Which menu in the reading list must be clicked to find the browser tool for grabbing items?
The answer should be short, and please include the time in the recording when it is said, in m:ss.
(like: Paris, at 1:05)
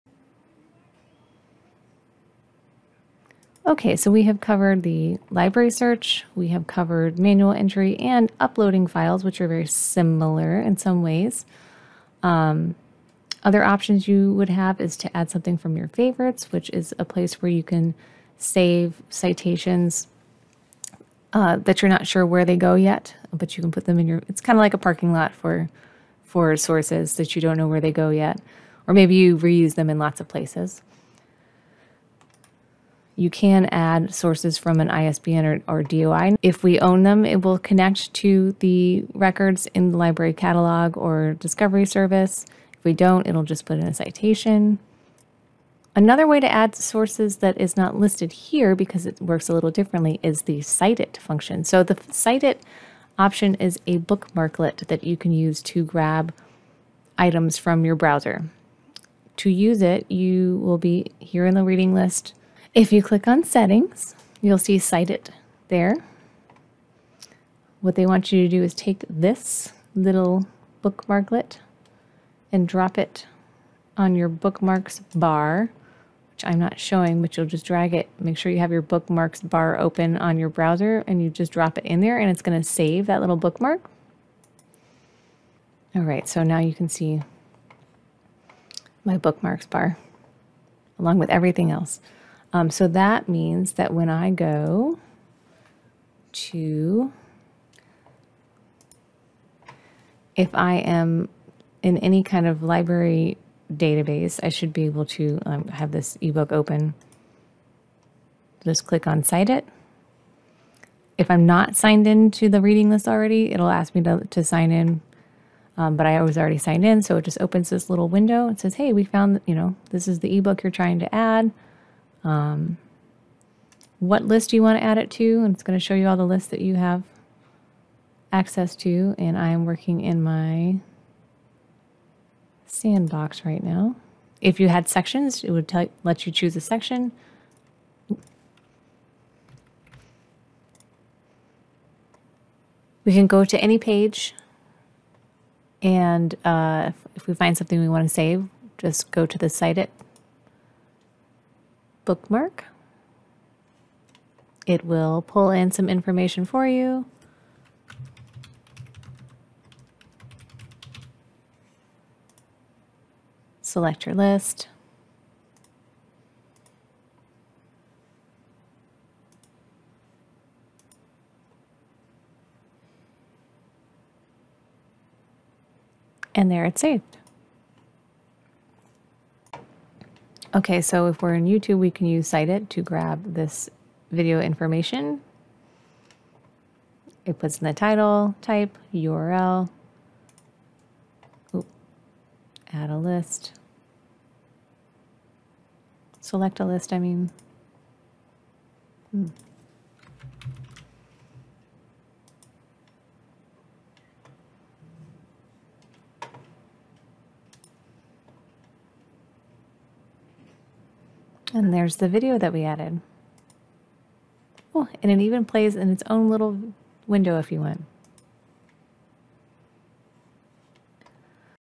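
settings, at 1:03.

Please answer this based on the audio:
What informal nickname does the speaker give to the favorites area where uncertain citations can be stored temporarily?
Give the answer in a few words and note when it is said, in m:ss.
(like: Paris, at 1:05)
parking lot, at 0:24.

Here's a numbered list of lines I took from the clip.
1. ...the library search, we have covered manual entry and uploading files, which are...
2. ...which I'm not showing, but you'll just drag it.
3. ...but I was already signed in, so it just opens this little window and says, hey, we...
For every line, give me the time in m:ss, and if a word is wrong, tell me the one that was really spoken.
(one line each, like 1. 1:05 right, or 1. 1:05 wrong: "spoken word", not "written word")
1. 0:04 right
2. 1:16 right
3. 1:55 right.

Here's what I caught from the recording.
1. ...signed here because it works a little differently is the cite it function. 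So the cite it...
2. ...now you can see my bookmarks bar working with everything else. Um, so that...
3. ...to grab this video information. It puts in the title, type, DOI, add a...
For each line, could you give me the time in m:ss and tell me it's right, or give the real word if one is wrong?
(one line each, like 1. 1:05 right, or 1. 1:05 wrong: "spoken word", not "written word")
1. 0:47 wrong: "listed", not "signed"
2. 1:26 wrong: "along", not "working"
3. 3:02 wrong: "URL", not "DOI".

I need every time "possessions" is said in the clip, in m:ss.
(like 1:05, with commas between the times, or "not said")
not said.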